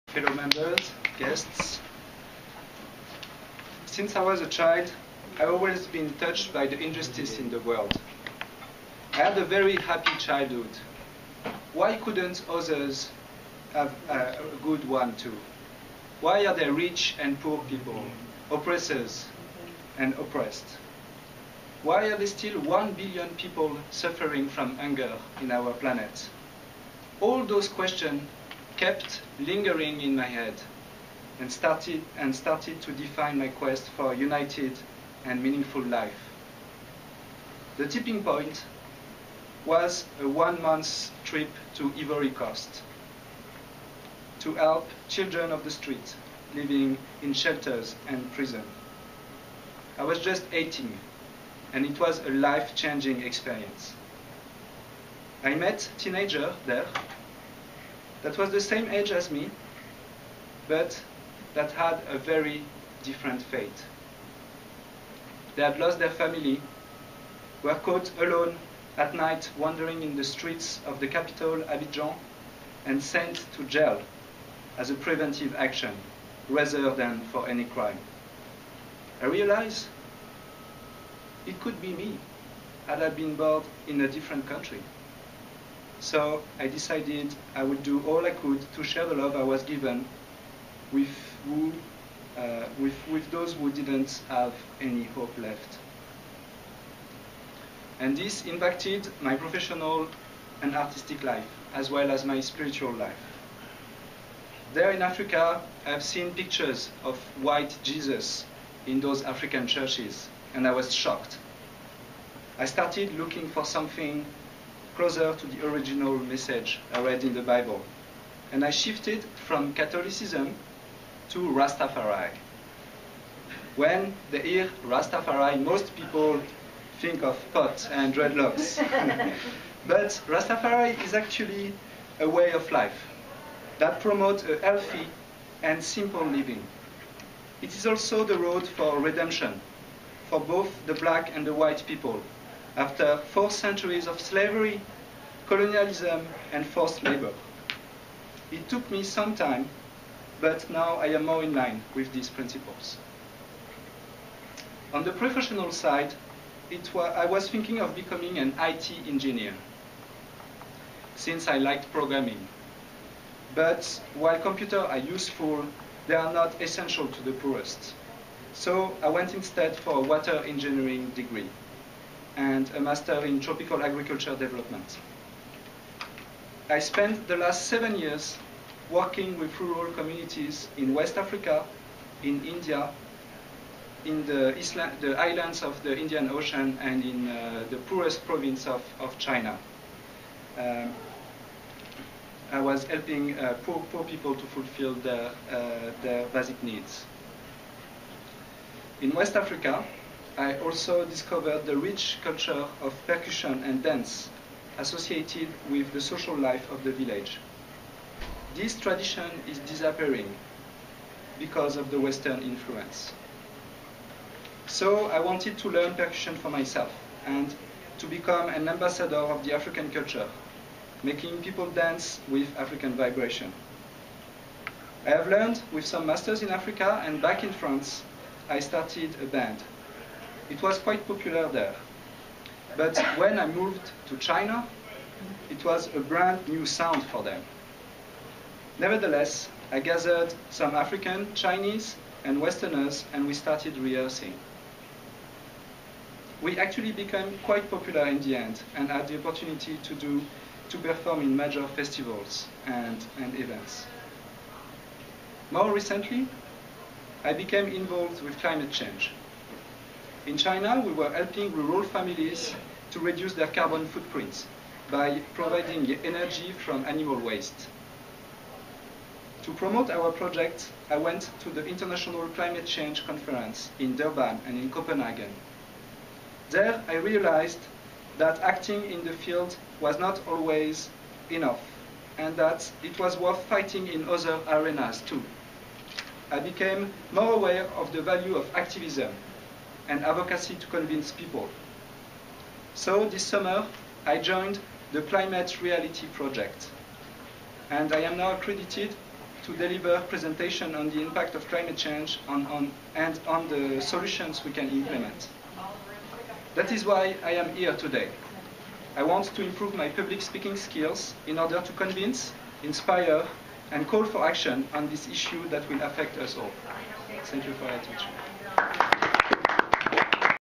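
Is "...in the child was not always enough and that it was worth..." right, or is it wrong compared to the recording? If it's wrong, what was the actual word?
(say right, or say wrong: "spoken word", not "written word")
wrong: "field", not "child".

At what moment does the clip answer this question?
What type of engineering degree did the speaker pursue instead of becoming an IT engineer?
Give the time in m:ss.
2:49.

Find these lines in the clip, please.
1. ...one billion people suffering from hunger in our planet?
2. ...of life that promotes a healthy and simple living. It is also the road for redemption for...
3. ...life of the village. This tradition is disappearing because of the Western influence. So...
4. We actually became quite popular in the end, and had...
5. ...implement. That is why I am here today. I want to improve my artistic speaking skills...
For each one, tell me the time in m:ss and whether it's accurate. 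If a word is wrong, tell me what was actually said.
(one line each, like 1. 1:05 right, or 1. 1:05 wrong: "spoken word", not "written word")
1. 0:22 right
2. 2:12 right
3. 3:26 right
4. 4:06 right
5. 5:04 wrong: "public", not "artistic".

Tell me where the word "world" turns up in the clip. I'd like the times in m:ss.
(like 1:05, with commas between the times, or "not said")
0:07.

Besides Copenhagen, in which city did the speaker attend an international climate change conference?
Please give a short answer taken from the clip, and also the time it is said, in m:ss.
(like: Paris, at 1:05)
Durban, at 4:33.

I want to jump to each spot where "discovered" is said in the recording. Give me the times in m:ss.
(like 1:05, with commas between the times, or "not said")
3:21.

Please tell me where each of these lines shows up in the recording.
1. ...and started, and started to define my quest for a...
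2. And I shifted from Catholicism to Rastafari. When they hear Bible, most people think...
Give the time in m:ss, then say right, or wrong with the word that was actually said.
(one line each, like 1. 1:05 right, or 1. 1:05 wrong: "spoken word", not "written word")
1. 0:31 right
2. 1:58 wrong: "Rastafari", not "Bible".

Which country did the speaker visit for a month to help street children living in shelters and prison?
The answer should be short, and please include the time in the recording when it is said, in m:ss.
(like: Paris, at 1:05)
Ivory Coast, at 0:41.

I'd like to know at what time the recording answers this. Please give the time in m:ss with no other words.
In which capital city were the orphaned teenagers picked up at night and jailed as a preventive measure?
1:11.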